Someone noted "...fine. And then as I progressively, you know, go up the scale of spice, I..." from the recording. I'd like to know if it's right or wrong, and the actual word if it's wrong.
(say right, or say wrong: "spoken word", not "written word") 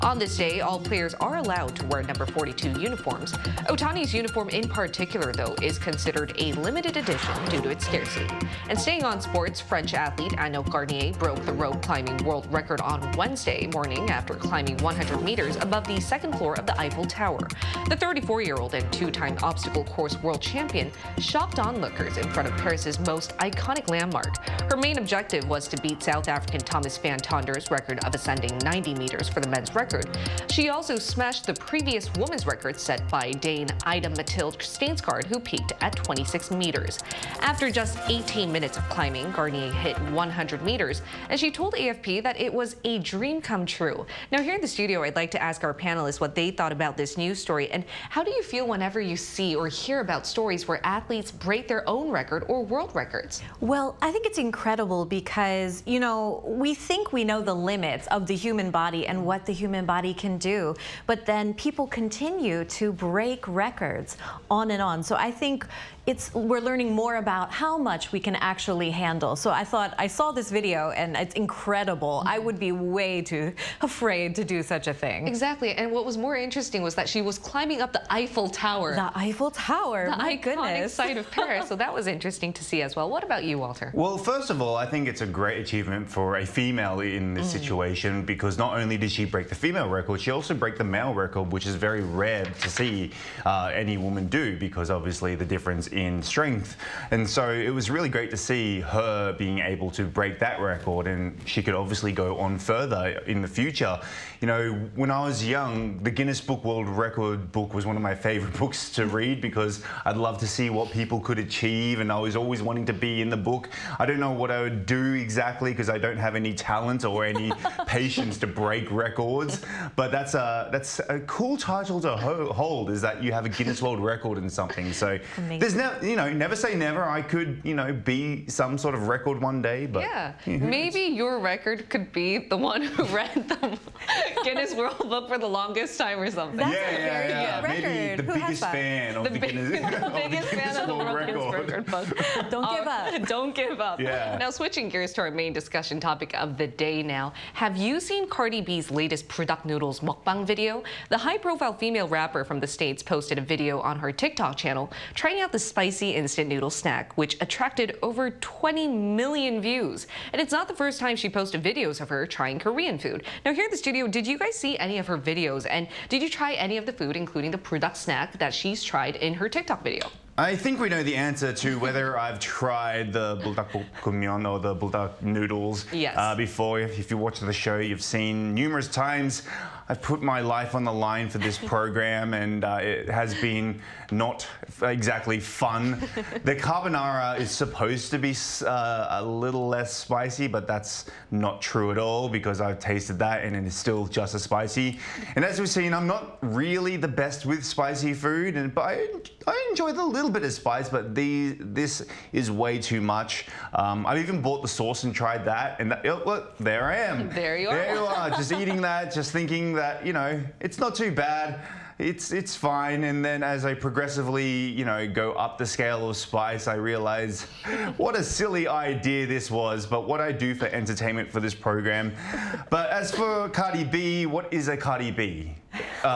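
right.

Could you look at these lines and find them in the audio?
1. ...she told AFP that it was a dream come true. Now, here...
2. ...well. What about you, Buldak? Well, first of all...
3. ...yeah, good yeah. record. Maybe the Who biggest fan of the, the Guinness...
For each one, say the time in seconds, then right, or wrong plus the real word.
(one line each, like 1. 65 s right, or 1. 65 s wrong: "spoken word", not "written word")
1. 41 s right
2. 82 s wrong: "Walter", not "Buldak"
3. 137 s right.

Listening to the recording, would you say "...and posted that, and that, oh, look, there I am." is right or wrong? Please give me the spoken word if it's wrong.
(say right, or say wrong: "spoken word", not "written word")
wrong: "tried", not "posted".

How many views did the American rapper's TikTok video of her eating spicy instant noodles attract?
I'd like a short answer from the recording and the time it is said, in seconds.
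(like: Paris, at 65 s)
Over 20 million, at 158 s.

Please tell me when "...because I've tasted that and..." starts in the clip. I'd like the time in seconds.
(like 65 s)
192 s.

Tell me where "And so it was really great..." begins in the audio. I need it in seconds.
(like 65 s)
97 s.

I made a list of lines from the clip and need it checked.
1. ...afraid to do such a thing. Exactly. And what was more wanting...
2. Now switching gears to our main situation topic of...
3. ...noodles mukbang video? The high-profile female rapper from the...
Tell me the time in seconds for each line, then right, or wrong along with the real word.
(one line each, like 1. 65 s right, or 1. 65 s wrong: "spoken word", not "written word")
1. 73 s wrong: "interesting", not "wanting"
2. 144 s wrong: "discussion", not "situation"
3. 149 s right.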